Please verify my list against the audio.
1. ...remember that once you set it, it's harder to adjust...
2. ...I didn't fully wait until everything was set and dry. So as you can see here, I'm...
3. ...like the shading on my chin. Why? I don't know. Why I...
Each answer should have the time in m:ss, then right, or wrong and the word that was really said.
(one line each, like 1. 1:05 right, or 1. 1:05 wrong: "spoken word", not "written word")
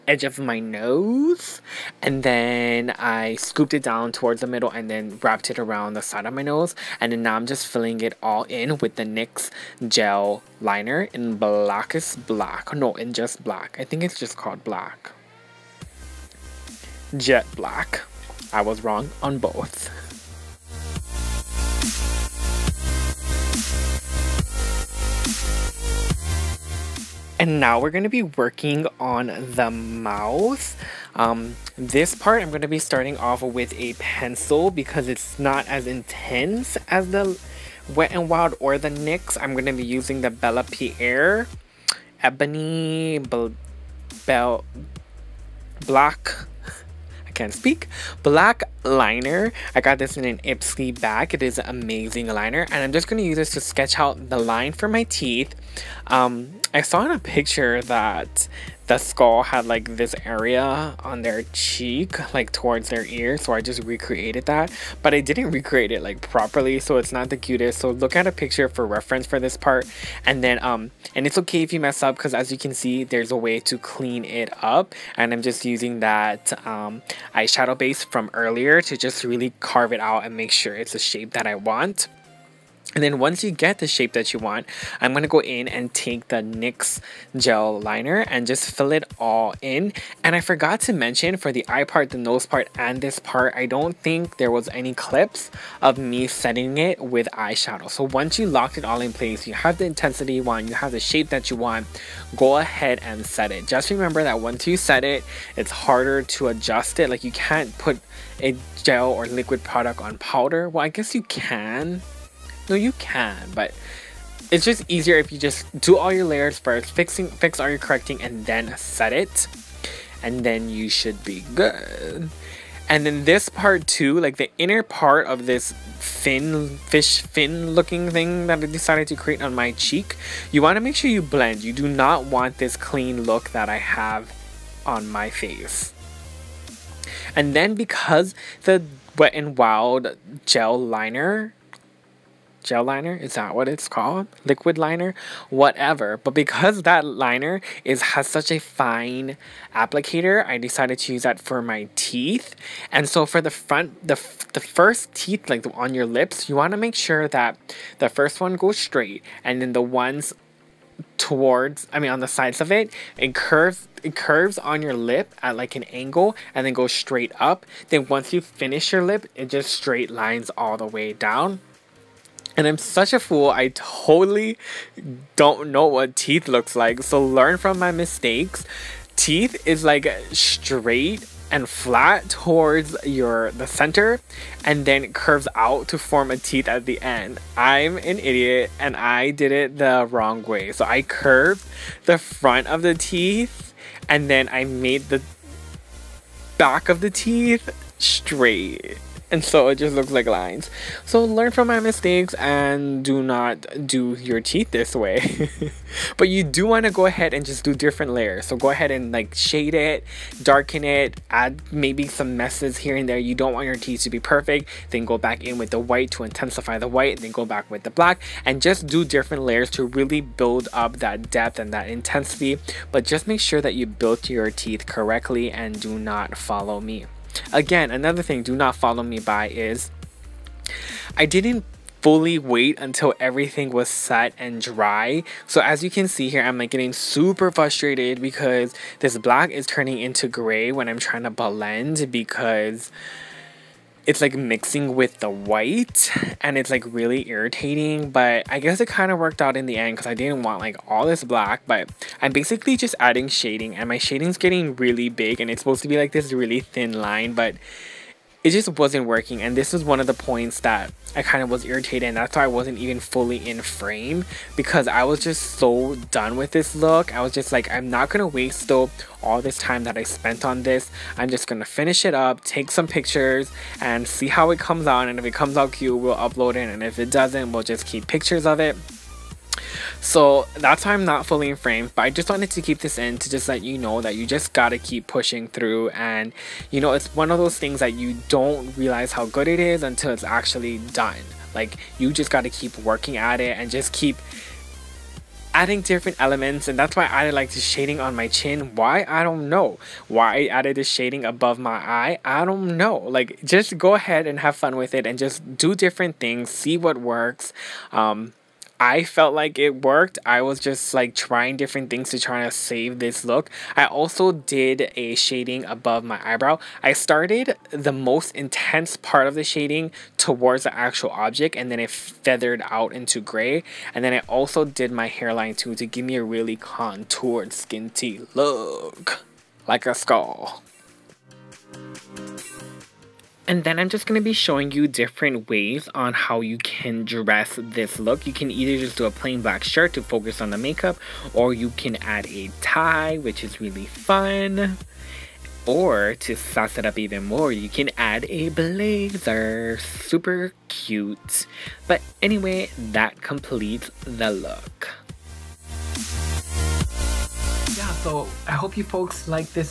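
1. 1:43 right
2. 3:51 right
3. 4:57 right.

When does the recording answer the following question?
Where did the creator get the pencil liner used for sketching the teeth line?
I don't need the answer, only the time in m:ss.
0:50.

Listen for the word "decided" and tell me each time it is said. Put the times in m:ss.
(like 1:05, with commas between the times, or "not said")
2:08, 2:30.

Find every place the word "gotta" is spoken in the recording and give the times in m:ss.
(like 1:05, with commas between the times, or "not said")
4:44, 4:52.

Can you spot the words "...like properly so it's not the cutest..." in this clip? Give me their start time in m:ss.
1:06.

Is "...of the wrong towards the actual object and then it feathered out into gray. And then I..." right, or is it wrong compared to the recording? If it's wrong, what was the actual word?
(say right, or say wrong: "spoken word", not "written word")
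wrong: "shading", not "wrong".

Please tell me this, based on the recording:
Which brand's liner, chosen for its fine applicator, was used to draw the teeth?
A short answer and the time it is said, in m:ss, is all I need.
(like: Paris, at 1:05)
Wet n Wild, at 2:19.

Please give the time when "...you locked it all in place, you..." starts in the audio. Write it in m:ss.
1:38.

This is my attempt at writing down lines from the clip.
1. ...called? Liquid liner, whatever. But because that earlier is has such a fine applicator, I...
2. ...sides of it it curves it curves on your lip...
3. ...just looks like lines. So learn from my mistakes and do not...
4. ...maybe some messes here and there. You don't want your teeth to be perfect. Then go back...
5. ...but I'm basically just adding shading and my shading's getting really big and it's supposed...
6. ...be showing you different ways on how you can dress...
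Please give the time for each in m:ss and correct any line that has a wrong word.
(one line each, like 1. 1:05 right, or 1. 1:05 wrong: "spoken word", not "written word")
1. 2:23 wrong: "liner", not "earlier"
2. 2:42 right
3. 3:19 right
4. 3:31 right
5. 4:11 right
6. 5:34 right.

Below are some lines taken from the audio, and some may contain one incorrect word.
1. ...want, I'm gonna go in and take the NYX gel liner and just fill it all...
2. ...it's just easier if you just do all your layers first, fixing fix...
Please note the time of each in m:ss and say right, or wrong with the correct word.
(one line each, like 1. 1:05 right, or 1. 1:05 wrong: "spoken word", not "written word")
1. 1:24 right
2. 1:54 right.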